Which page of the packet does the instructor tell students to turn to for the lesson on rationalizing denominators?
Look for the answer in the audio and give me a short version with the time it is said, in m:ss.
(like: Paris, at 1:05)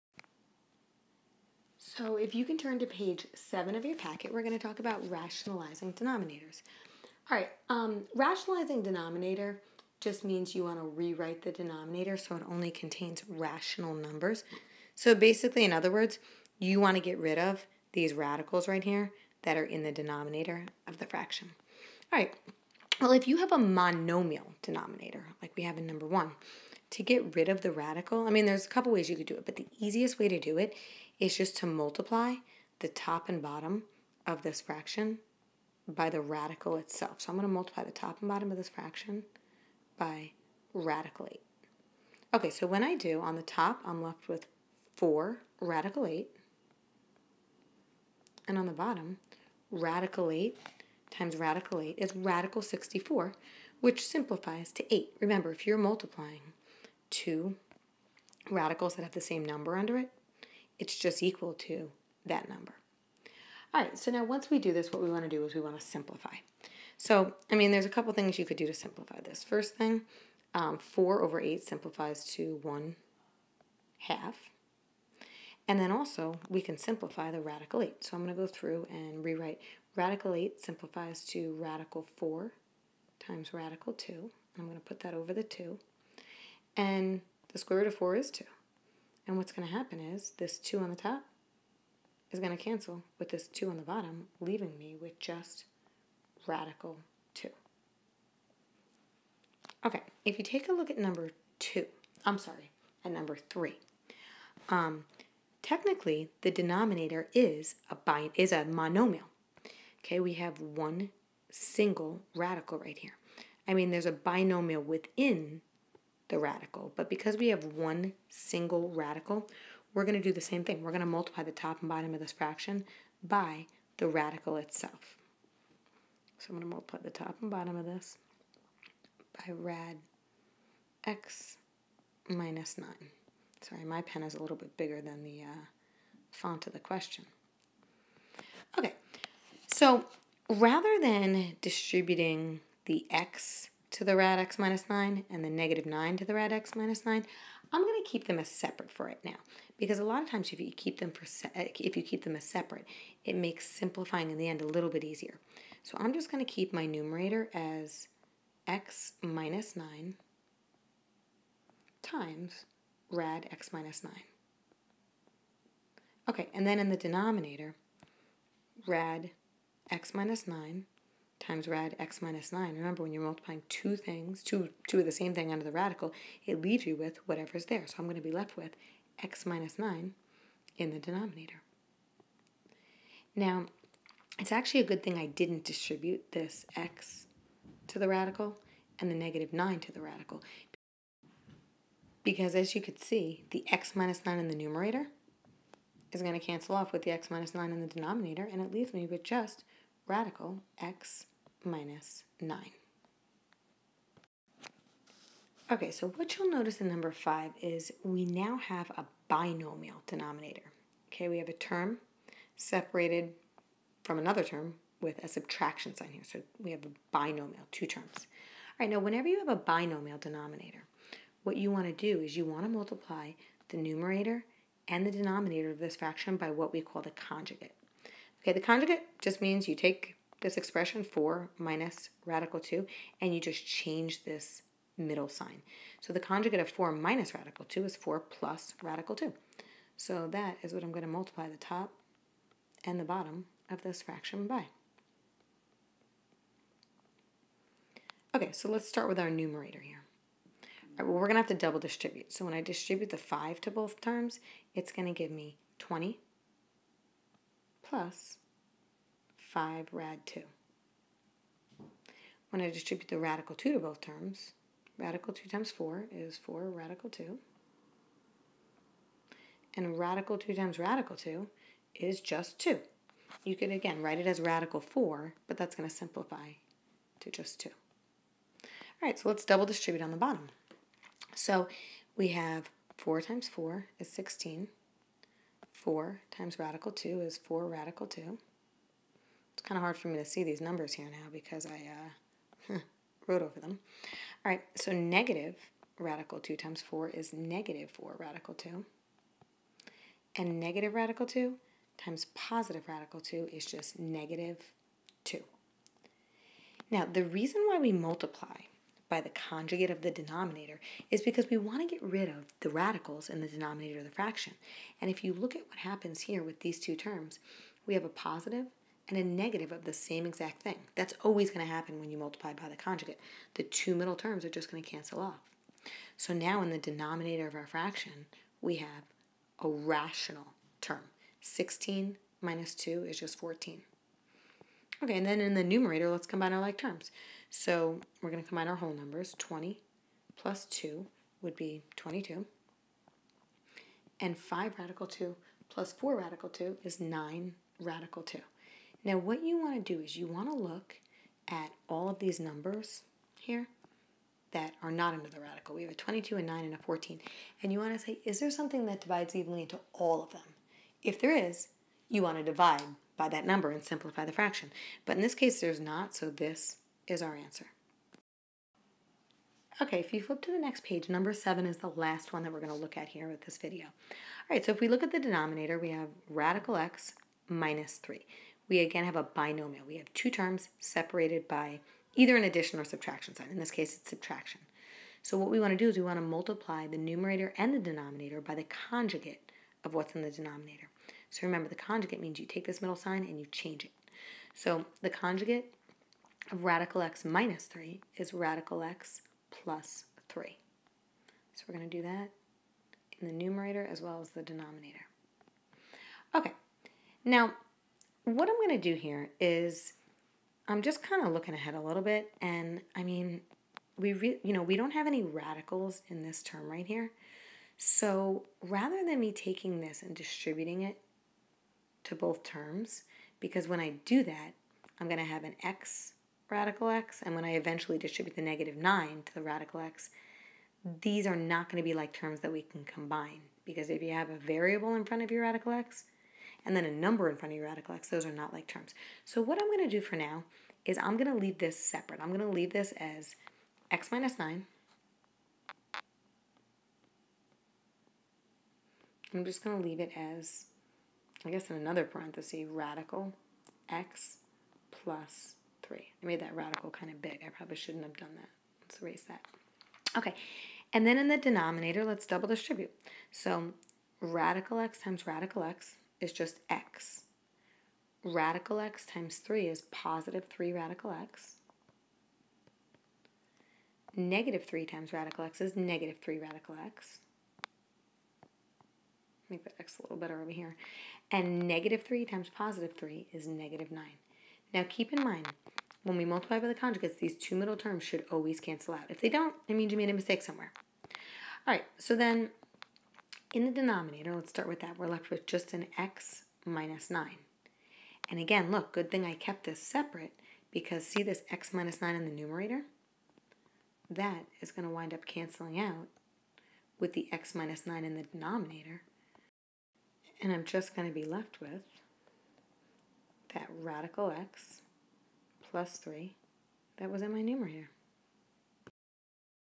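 page 7, at 0:02.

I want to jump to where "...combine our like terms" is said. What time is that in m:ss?
5:36.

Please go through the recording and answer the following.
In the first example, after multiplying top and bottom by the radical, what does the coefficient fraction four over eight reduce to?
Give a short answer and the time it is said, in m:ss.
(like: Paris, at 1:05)
1/2, at 1:12.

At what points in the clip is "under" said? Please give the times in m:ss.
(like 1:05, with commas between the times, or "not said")
0:59, 2:55, 5:55.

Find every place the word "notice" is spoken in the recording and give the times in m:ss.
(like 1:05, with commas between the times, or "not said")
3:26.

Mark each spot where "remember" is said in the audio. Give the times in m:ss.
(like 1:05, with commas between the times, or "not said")
0:55, 2:52, 6:31.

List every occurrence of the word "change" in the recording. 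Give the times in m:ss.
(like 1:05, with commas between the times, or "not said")
3:53, 6:33.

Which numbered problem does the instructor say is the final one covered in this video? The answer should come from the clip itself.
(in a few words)
7.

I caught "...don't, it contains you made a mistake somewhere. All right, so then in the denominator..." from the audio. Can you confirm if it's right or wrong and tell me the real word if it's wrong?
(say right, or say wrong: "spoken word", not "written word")
wrong: "means", not "contains".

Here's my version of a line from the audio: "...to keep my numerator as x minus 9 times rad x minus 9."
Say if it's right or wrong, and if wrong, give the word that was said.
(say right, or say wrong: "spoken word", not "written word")
right.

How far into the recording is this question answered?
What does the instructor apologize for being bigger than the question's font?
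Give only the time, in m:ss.
2:13.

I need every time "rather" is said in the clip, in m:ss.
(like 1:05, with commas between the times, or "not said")
2:20, 6:58.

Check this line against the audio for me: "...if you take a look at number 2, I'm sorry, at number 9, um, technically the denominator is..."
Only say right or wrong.
wrong.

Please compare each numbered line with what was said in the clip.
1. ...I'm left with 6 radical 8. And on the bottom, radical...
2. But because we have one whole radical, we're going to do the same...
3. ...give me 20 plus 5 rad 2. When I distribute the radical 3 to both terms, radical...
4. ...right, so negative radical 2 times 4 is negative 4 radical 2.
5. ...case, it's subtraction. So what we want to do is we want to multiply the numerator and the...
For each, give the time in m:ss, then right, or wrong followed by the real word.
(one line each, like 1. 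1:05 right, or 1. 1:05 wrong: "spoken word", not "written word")
1. 0:43 wrong: "4", not "6"
2. 1:56 wrong: "single", not "whole"
3. 4:15 wrong: "2", not "3"
4. 4:54 right
5. 6:23 right.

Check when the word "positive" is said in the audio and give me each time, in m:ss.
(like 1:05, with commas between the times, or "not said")
5:02, 5:18, 7:49, 8:02.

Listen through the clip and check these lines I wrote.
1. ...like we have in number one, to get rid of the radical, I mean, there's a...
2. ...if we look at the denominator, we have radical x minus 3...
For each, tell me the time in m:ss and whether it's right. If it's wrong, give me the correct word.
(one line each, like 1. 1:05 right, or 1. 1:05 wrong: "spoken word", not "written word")
1. 0:25 right
2. 6:14 right.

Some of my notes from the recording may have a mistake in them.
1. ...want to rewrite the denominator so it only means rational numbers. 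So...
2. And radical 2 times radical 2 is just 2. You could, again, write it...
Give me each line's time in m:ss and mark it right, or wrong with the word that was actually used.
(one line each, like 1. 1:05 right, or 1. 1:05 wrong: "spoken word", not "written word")
1. 0:10 wrong: "contains", not "means"
2. 4:29 right.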